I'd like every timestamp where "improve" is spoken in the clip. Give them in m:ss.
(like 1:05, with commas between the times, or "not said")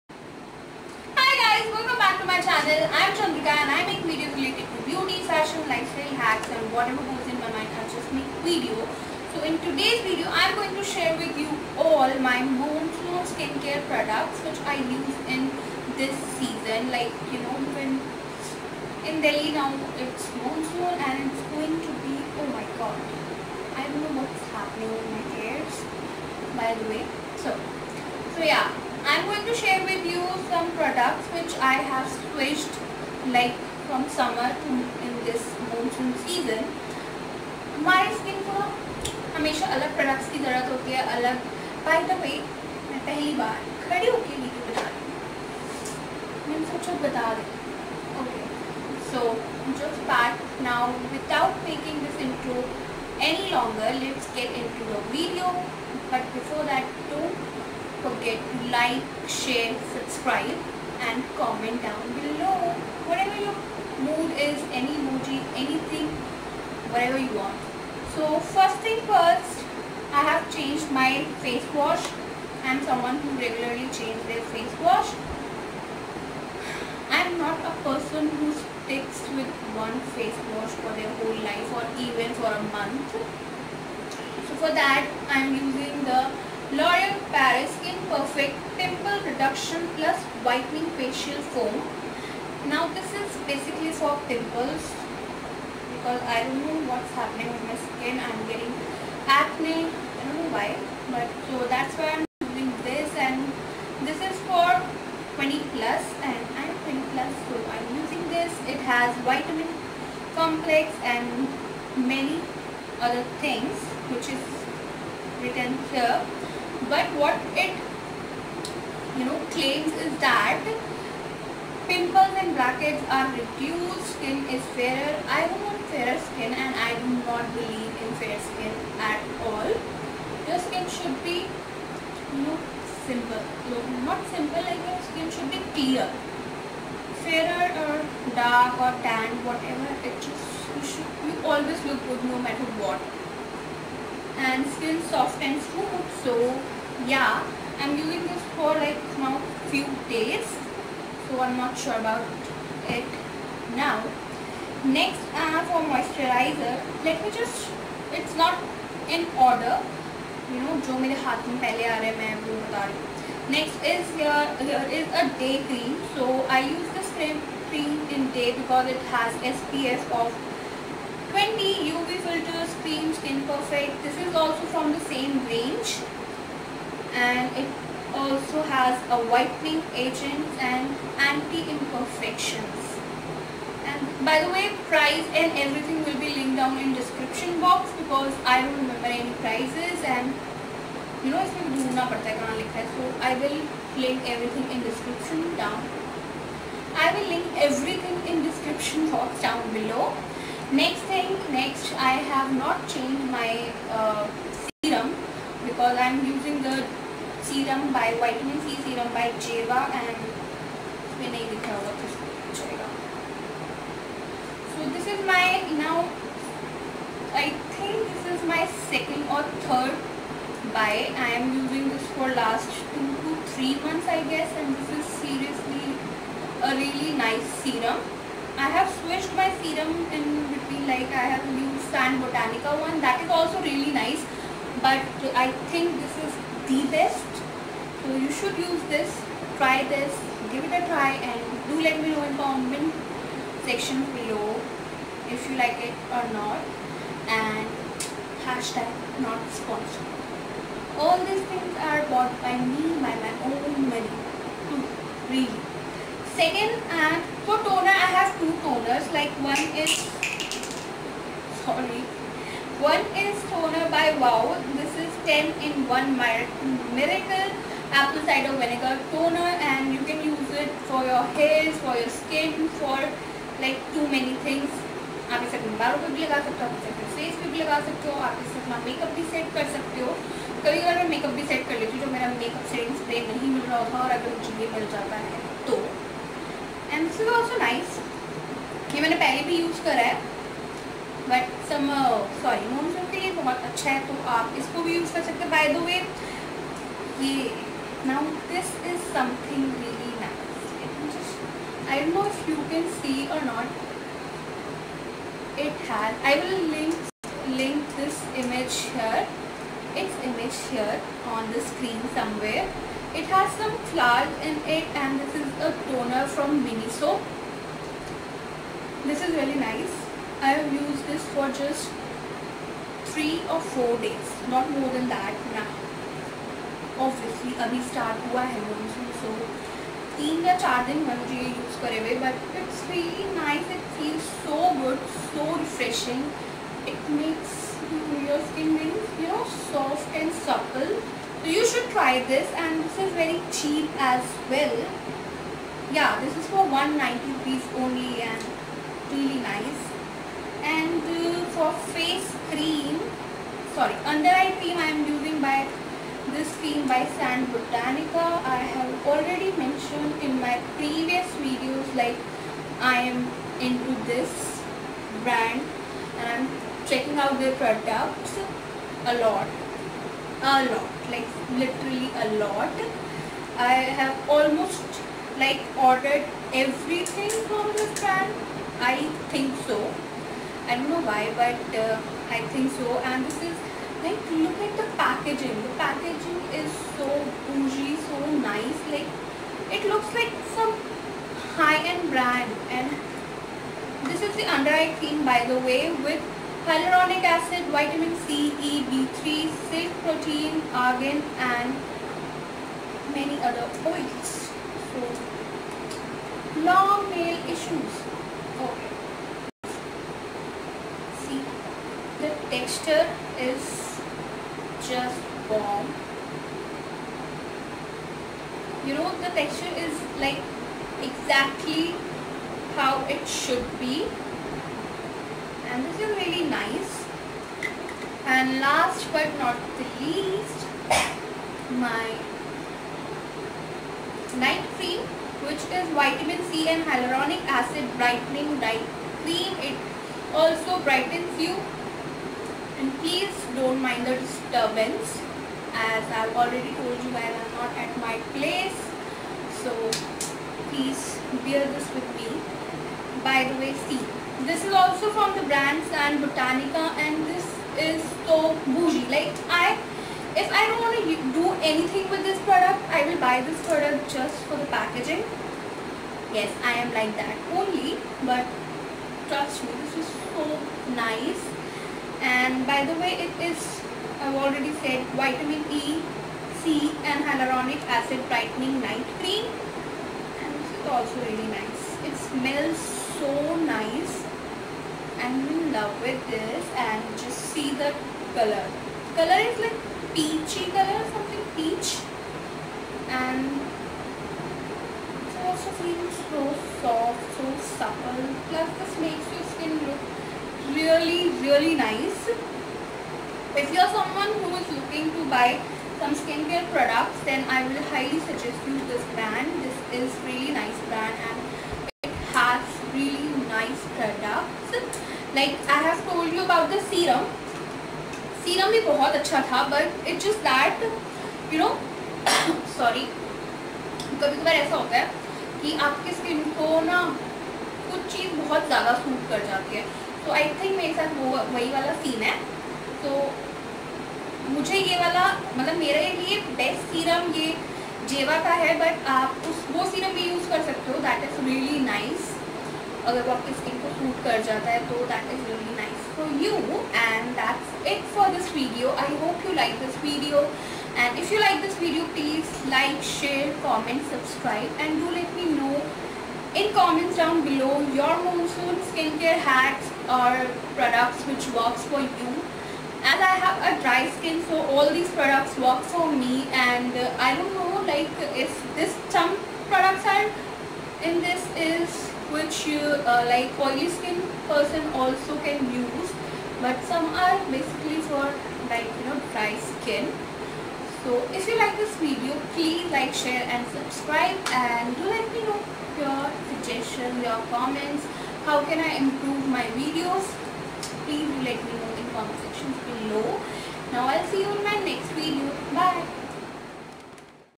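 9:49.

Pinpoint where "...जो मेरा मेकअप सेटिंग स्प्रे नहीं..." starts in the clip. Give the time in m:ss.
4:42.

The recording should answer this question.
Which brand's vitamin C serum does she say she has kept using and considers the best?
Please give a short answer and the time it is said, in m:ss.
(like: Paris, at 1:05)
Jeva, at 3:29.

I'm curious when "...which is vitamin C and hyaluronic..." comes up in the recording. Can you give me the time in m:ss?
7:15.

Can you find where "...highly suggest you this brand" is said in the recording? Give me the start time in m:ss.
8:27.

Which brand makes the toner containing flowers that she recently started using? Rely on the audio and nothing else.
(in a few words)
Miniso.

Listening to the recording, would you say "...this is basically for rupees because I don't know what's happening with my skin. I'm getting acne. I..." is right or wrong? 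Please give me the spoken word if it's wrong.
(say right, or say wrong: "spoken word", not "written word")
wrong: "pimples", not "rupees".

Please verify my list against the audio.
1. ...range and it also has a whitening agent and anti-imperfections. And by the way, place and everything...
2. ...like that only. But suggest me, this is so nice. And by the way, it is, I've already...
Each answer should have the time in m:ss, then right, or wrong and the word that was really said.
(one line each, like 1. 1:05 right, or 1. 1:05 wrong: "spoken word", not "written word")
1. 2:55 wrong: "price", not "place"
2. 7:46 wrong: "trust", not "suggest".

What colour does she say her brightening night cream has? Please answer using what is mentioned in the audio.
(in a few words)
Peach.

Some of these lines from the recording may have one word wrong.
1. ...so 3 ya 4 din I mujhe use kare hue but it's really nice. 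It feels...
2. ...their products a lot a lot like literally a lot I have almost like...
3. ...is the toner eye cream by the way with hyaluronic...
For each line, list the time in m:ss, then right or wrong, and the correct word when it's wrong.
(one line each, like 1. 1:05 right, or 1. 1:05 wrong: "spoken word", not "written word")
1. 5:29 right
2. 6:07 right
3. 6:34 wrong: "under", not "toner".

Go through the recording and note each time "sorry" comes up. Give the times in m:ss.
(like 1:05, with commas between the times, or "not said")
4:21, 5:53.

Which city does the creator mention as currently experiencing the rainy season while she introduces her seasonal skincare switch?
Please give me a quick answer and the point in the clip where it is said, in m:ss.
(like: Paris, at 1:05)
Delhi, at 0:19.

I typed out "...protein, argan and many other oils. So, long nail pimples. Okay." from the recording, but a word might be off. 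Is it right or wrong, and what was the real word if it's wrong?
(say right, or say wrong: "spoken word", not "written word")
wrong: "issues", not "pimples".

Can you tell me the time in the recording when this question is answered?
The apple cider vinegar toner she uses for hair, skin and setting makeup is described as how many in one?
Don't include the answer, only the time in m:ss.
4:25.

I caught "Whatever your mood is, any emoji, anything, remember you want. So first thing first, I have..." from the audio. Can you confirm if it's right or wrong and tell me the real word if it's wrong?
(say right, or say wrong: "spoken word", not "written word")
wrong: "whatever", not "remember".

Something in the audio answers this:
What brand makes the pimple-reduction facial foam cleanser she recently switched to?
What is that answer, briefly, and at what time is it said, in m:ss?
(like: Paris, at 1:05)
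L'Oreal Paris, at 1:26.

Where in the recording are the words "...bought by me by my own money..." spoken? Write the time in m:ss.
4:12.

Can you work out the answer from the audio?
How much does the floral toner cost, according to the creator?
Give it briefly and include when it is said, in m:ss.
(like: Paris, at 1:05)
190 rupees, at 5:46.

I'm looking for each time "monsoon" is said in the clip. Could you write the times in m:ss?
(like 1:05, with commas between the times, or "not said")
0:12, 0:20, 0:35, 5:28, 9:18.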